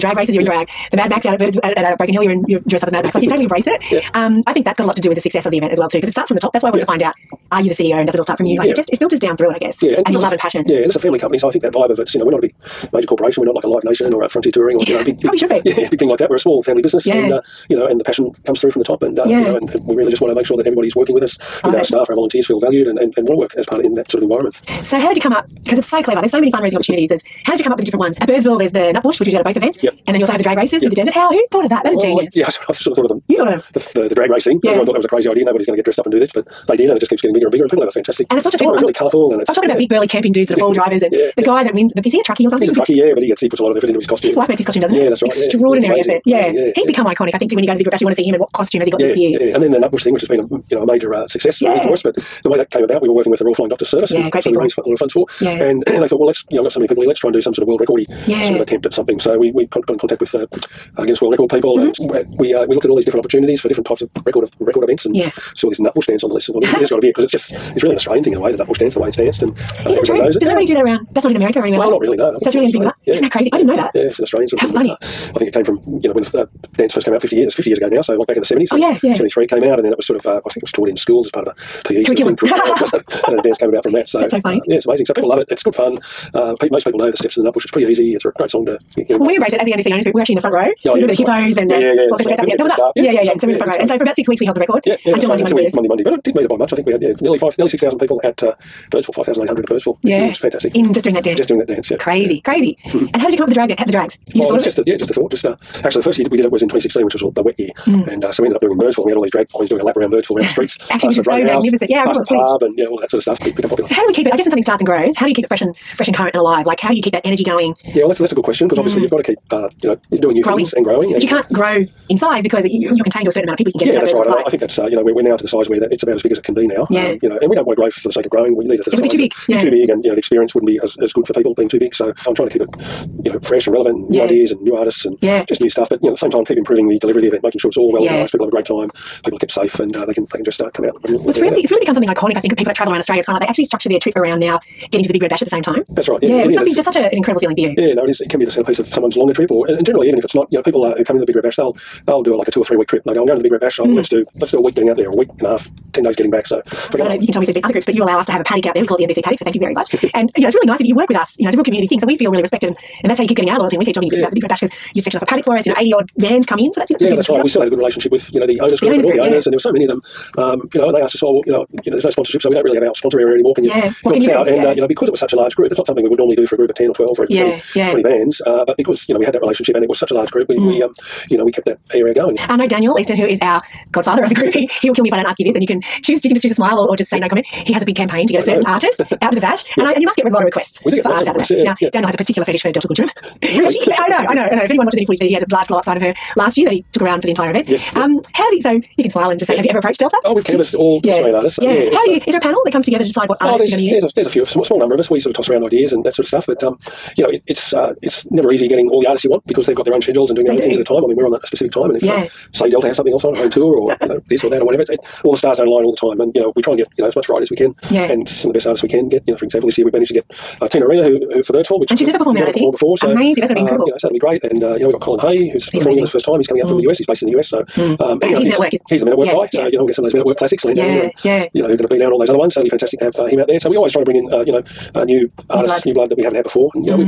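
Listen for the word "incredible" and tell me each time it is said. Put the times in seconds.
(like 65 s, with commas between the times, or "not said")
147 s, 223 s.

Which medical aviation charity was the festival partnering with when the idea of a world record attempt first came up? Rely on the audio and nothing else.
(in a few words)
Royal Flying Doctors Service.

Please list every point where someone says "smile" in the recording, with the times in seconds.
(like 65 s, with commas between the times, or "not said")
186 s, 199 s.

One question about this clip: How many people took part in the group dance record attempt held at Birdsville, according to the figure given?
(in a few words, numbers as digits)
5,800.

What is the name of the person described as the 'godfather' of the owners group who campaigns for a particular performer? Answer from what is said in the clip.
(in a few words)
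Daniel Easton.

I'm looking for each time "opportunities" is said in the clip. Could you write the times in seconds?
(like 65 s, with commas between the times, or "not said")
26 s, 63 s.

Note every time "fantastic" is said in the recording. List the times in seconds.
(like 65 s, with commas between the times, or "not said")
37 s, 100 s, 232 s.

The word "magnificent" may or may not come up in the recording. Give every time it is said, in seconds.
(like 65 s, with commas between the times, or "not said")
111 s.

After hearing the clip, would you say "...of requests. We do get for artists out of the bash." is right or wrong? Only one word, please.
right.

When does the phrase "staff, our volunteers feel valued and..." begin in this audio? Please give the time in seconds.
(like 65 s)
21 s.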